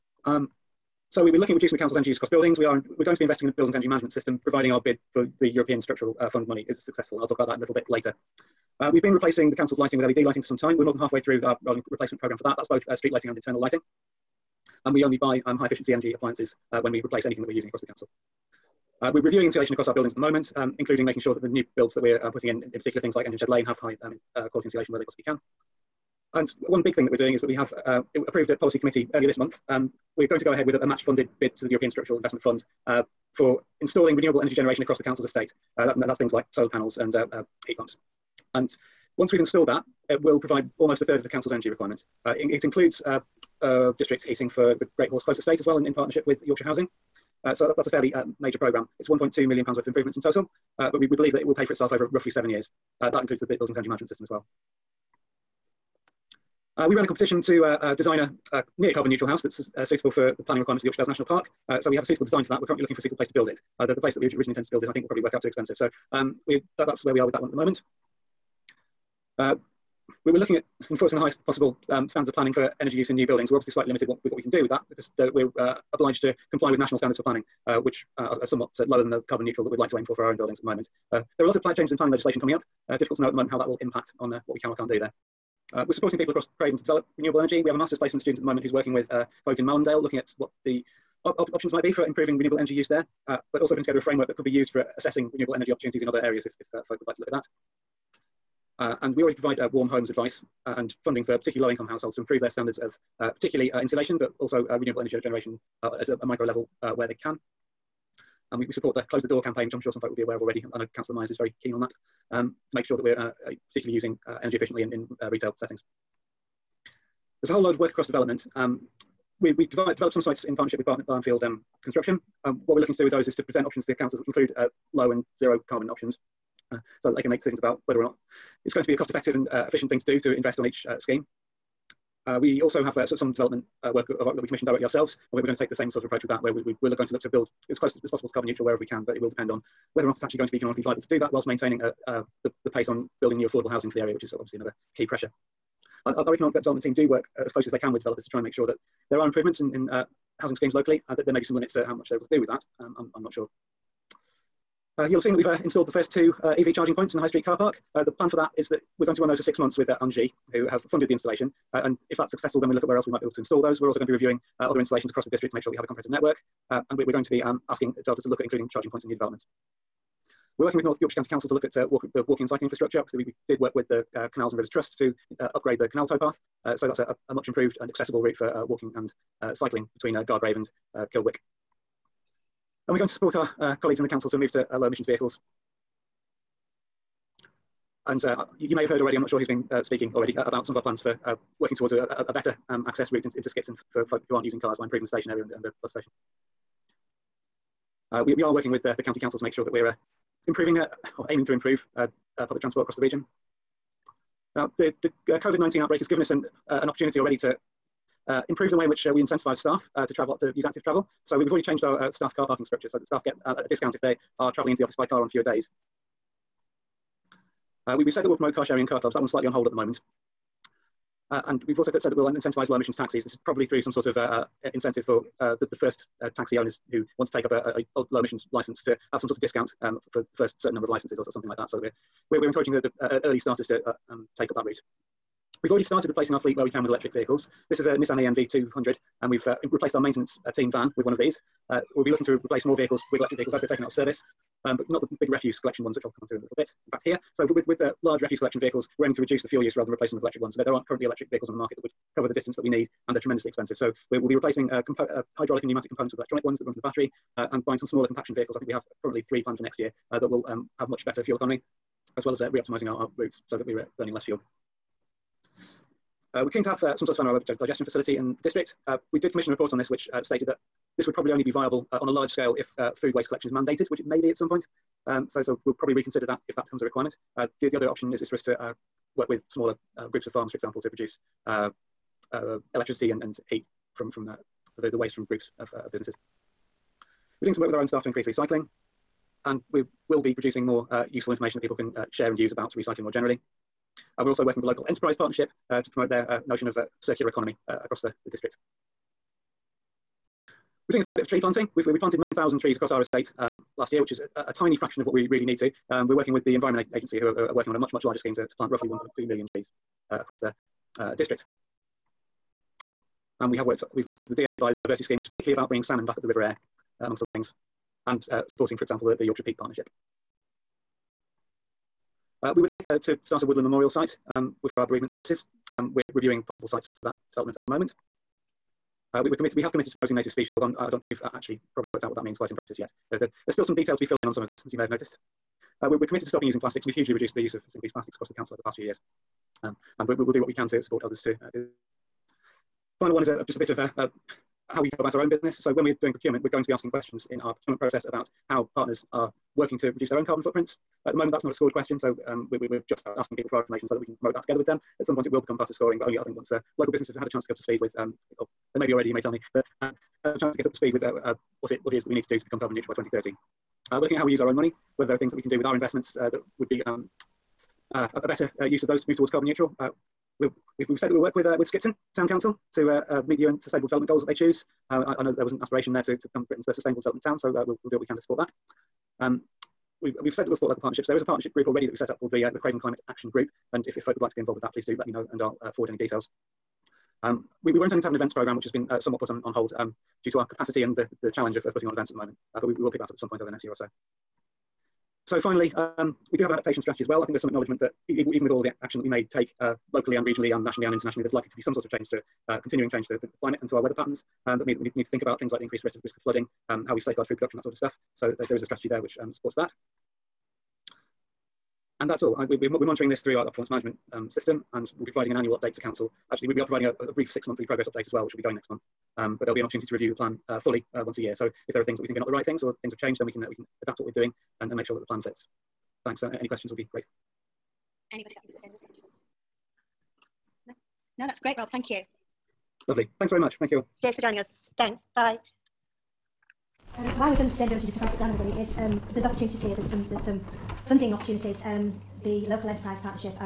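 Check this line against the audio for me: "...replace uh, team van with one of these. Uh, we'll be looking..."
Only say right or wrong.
wrong.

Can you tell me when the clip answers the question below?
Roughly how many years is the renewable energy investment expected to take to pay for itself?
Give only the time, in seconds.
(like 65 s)
52 s.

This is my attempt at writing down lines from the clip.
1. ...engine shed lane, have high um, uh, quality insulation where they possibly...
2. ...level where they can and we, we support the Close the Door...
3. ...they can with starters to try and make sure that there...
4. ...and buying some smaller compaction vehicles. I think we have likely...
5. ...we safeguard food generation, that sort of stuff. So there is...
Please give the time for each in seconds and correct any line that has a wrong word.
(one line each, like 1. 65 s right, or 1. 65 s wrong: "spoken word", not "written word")
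1. 23 s right
2. 106 s right
3. 147 s wrong: "developers", not "starters"
4. 257 s wrong: "currently", not "likely"
5. 406 s wrong: "production", not "generation".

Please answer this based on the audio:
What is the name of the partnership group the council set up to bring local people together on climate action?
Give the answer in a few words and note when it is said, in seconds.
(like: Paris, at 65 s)
Craven Climate Action Group, at 382 s.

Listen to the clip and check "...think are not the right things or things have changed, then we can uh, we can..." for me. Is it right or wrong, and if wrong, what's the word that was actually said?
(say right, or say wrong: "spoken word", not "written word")
right.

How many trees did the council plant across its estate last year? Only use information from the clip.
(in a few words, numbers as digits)
9,000.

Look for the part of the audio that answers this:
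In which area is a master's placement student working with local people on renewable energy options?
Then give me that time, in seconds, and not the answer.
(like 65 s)
89 s.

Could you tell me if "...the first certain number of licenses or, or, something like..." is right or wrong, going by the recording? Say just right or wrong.
right.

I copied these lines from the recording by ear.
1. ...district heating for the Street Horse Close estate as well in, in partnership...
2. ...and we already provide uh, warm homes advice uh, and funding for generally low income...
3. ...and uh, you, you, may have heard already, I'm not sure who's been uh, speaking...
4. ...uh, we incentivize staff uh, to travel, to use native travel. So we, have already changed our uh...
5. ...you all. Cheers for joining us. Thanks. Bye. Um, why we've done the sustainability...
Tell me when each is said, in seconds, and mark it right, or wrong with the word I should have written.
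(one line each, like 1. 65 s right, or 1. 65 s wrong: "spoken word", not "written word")
1. 43 s wrong: "Great", not "Street"
2. 99 s wrong: "particularly", not "generally"
3. 188 s right
4. 209 s wrong: "active", not "native"
5. 433 s right.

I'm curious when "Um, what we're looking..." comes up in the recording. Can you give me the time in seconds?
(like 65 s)
122 s.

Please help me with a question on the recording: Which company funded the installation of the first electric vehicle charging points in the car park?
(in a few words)
Engie.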